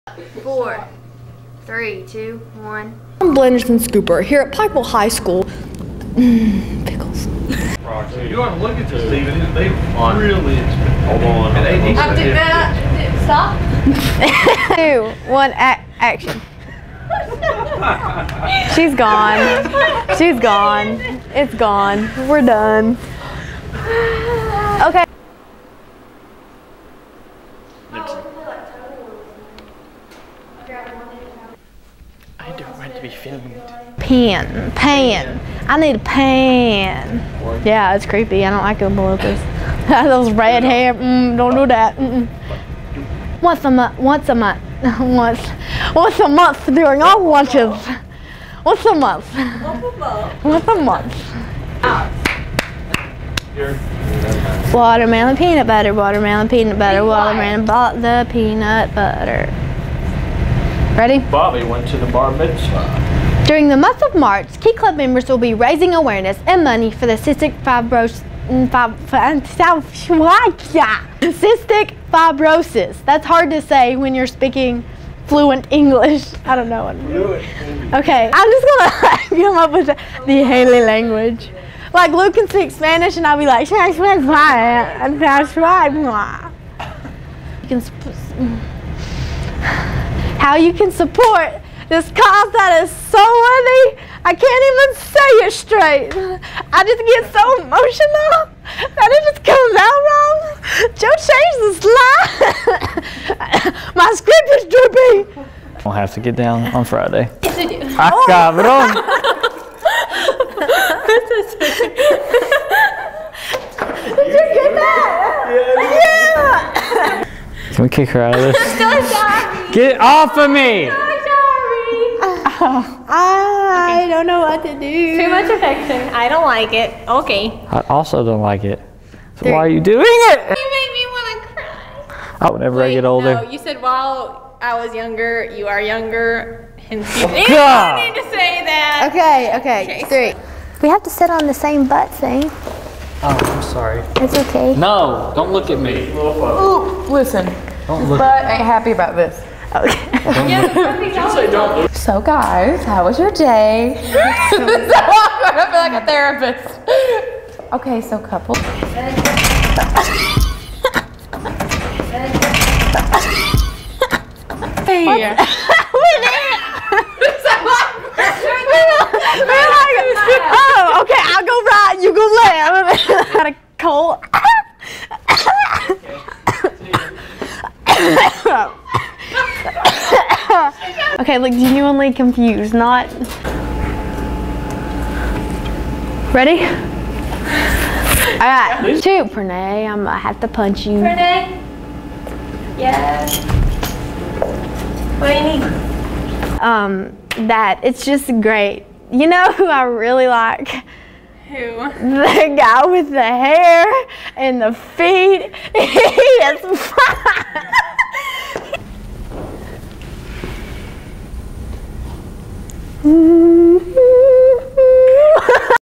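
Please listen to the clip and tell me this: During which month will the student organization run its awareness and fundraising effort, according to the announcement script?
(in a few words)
March.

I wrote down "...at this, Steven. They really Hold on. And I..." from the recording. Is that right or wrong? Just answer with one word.
right.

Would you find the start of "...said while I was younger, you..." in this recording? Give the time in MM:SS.
02:13.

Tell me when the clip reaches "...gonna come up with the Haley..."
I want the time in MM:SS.
01:18.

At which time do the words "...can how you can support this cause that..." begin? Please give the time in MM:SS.
01:27.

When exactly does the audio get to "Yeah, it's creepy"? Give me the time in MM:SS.
00:37.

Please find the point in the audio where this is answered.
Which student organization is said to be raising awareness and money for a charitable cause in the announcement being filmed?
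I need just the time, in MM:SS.
01:04.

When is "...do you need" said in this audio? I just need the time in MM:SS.
03:15.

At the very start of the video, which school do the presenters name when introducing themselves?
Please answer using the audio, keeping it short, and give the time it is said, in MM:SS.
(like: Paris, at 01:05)
Pikeville High School, at 00:04.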